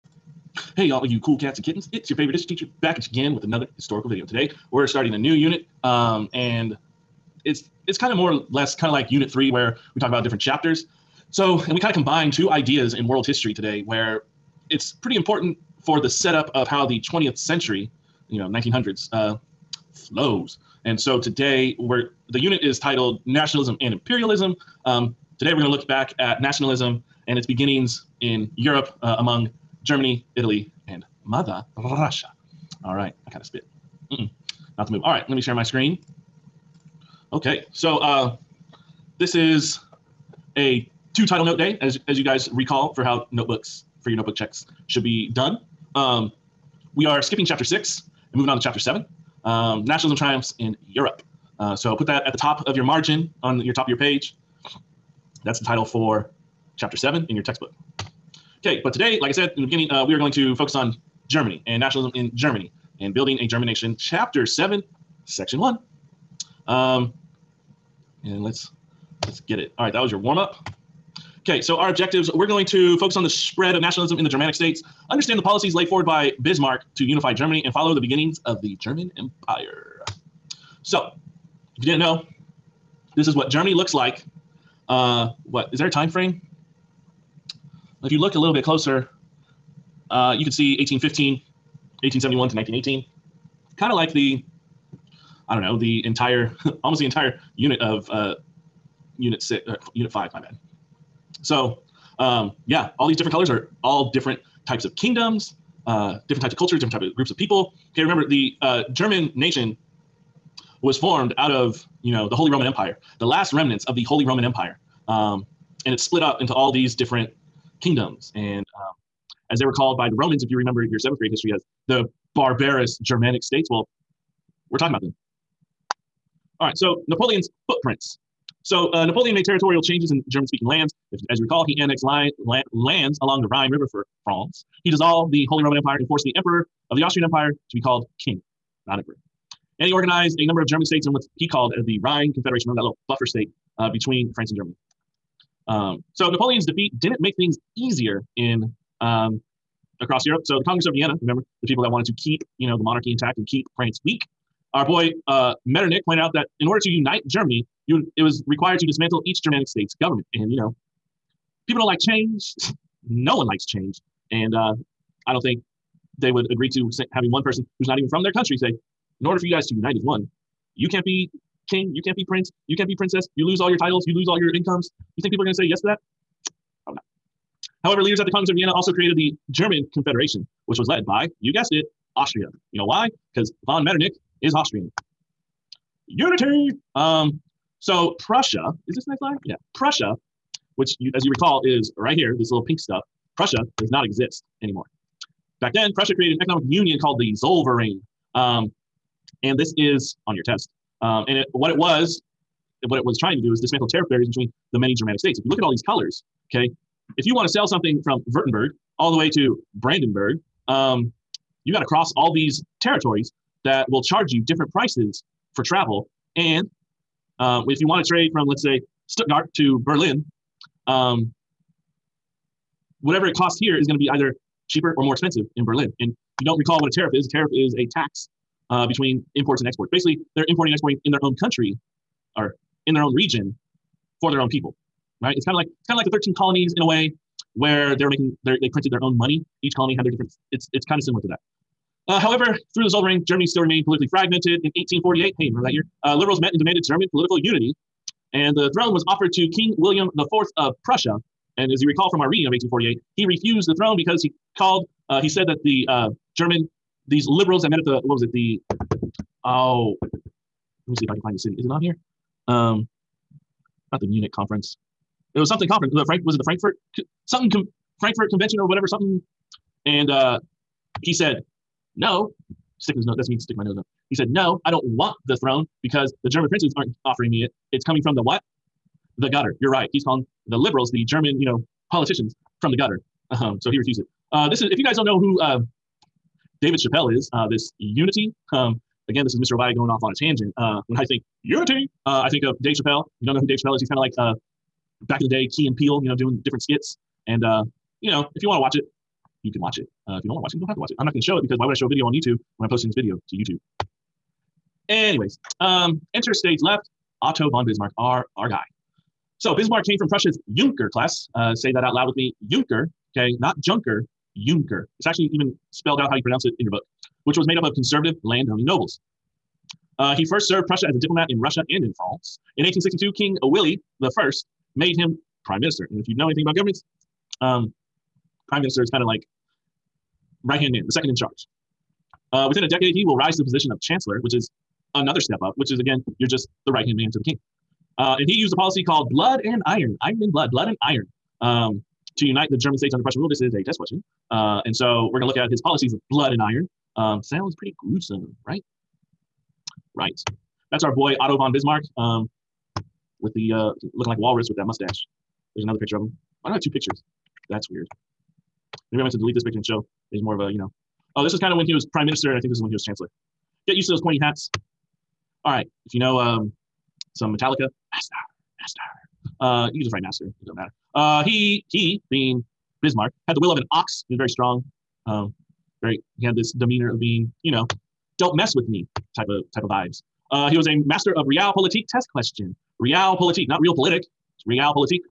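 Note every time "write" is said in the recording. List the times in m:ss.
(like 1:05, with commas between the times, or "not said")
6:09.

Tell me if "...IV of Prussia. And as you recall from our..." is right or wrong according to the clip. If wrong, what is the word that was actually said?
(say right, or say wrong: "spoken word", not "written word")
right.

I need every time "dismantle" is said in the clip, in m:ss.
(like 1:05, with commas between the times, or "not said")
2:38, 3:23.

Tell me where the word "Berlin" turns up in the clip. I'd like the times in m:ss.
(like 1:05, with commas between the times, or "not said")
3:39, 3:45.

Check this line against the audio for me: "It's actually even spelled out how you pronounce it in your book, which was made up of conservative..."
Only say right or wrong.
right.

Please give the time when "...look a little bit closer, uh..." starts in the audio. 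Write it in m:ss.
1:28.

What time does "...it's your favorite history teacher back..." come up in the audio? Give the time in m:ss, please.
0:01.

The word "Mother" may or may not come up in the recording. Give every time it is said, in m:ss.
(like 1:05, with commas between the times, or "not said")
0:31.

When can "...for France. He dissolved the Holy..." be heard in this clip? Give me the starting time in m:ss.
2:13.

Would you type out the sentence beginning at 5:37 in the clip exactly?
Uh, and he used a policy called blood and iron, iron and blood, blood and iron.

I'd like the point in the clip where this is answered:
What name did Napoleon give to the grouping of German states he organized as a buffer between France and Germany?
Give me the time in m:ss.
2:21.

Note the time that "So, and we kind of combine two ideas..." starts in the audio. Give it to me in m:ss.
0:11.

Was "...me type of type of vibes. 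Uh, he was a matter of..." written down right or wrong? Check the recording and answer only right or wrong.
wrong.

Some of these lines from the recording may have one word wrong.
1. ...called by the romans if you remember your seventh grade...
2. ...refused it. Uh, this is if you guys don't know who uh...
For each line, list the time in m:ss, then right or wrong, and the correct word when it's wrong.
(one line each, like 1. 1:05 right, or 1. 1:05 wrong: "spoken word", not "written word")
1. 1:59 right
2. 4:43 right.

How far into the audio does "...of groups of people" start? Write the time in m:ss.
1:47.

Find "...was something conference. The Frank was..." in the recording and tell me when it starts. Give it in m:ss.
4:25.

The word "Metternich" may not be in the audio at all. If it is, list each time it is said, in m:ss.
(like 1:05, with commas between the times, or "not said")
2:35, 3:03.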